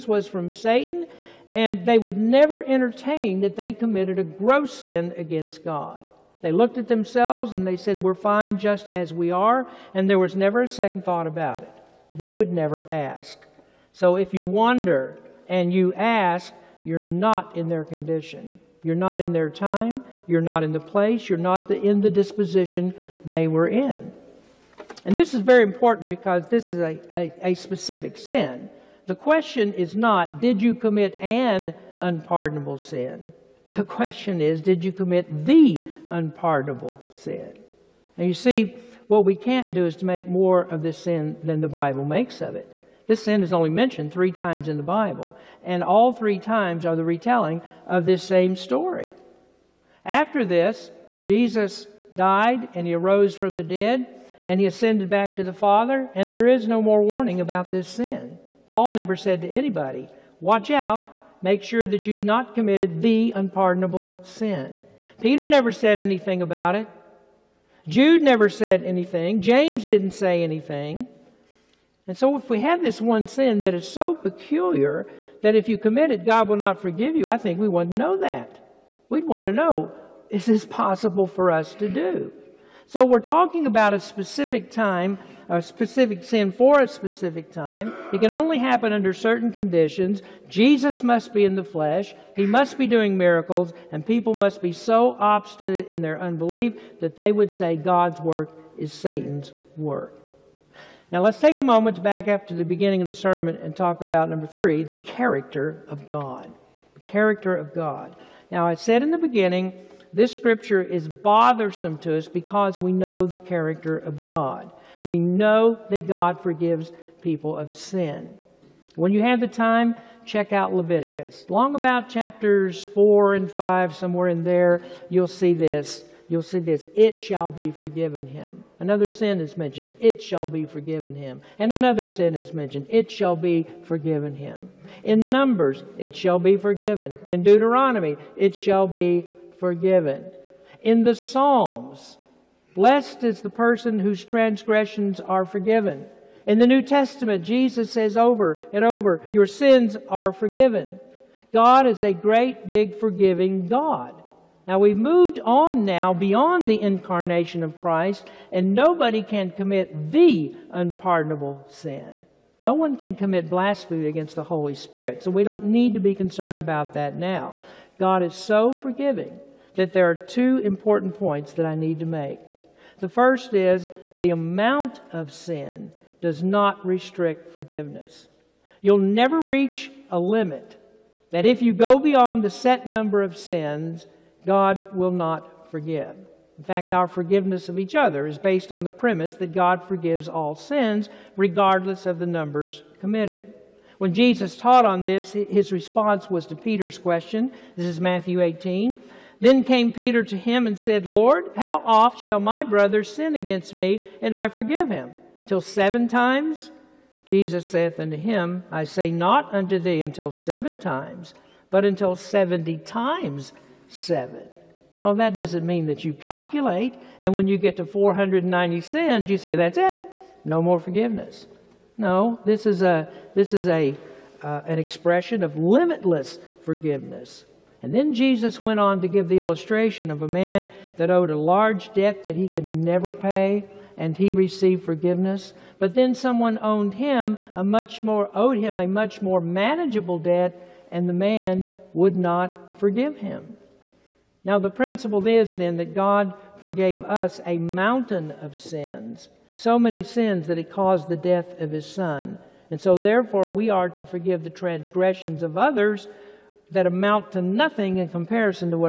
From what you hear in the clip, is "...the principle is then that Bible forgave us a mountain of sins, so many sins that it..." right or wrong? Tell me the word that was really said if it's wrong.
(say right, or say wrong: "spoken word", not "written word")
wrong: "God", not "Bible".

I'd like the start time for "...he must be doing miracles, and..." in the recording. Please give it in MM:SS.
01:32.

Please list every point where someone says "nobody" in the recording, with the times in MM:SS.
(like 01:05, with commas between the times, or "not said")
02:38.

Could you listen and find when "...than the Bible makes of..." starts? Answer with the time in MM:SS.
00:41.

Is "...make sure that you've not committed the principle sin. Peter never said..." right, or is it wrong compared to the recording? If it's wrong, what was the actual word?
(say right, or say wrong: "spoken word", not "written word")
wrong: "unpardonable", not "principle".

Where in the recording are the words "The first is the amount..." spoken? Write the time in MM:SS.
02:52.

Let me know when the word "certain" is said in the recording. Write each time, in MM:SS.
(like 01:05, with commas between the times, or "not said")
01:29.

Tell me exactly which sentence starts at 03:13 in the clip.
When Jesus taught on this, his response was to Peter's question.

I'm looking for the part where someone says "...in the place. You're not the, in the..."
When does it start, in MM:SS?
00:20.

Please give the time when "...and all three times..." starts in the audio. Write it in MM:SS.
00:45.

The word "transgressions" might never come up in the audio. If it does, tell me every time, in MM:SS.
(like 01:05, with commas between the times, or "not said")
02:24, 04:14.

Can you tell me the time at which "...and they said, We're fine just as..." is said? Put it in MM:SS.
00:07.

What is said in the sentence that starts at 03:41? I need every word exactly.
No, this is, a, this is a, uh, an expression of limitless forgiveness.